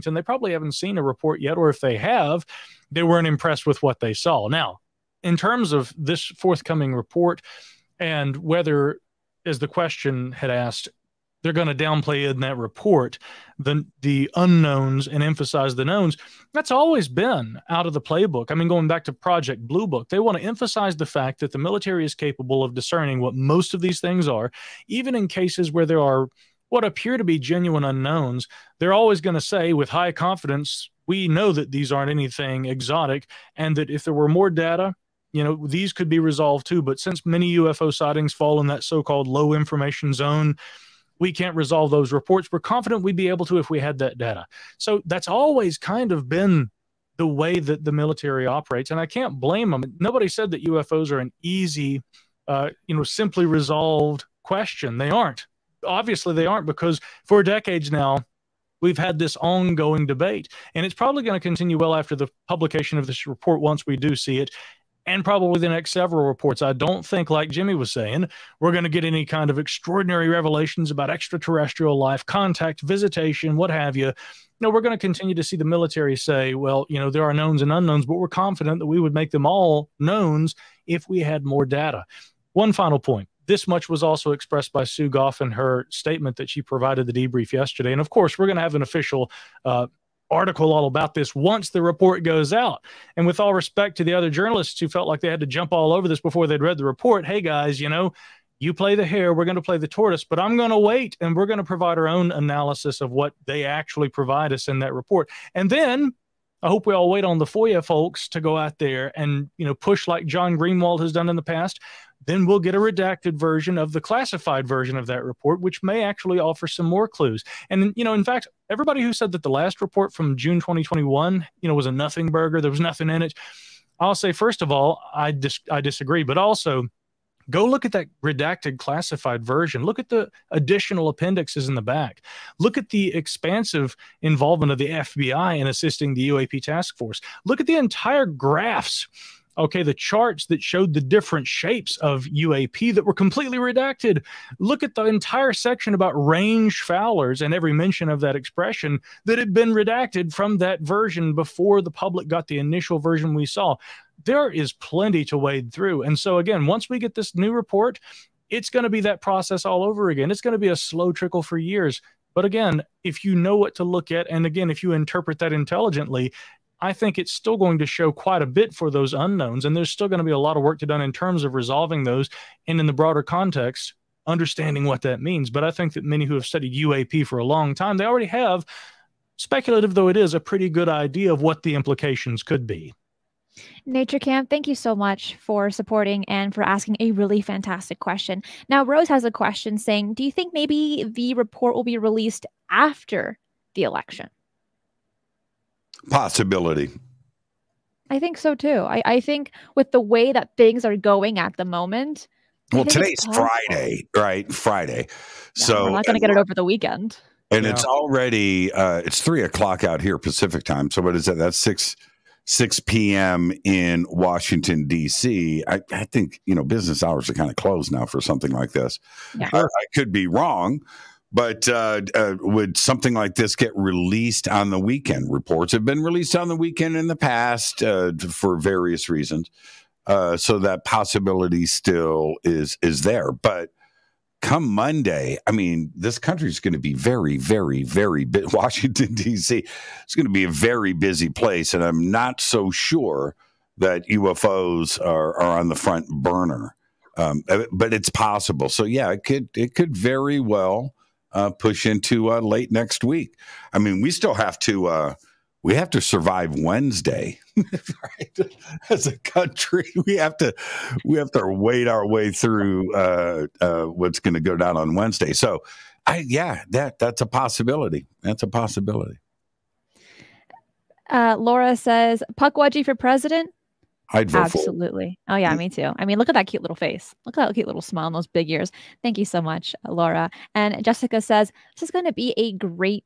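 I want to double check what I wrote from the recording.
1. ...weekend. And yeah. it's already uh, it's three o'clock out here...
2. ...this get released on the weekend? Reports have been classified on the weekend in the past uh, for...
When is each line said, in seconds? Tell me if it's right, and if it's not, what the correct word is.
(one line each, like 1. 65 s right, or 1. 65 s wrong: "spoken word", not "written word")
1. 206 s right
2. 223 s wrong: "released", not "classified".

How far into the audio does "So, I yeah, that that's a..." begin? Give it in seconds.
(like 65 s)
265 s.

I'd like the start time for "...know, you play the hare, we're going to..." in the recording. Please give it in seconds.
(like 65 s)
97 s.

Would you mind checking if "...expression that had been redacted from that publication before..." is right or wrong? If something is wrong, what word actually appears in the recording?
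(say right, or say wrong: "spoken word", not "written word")
wrong: "version", not "publication".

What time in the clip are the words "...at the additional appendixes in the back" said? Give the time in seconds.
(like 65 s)
129 s.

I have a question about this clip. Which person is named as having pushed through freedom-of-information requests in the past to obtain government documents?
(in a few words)
John Greenwald.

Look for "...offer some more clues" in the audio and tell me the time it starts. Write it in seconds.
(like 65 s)
116 s.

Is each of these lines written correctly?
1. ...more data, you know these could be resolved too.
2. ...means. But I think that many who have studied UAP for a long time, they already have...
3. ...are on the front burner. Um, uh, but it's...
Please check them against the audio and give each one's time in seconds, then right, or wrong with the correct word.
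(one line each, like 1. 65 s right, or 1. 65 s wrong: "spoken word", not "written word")
1. 34 s right
2. 175 s right
3. 245 s right.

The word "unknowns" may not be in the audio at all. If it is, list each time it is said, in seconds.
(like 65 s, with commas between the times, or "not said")
14 s, 27 s, 77 s, 169 s.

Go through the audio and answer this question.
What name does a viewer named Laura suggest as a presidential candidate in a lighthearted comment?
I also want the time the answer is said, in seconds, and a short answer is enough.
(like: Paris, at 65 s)
Puckwudgie, at 272 s.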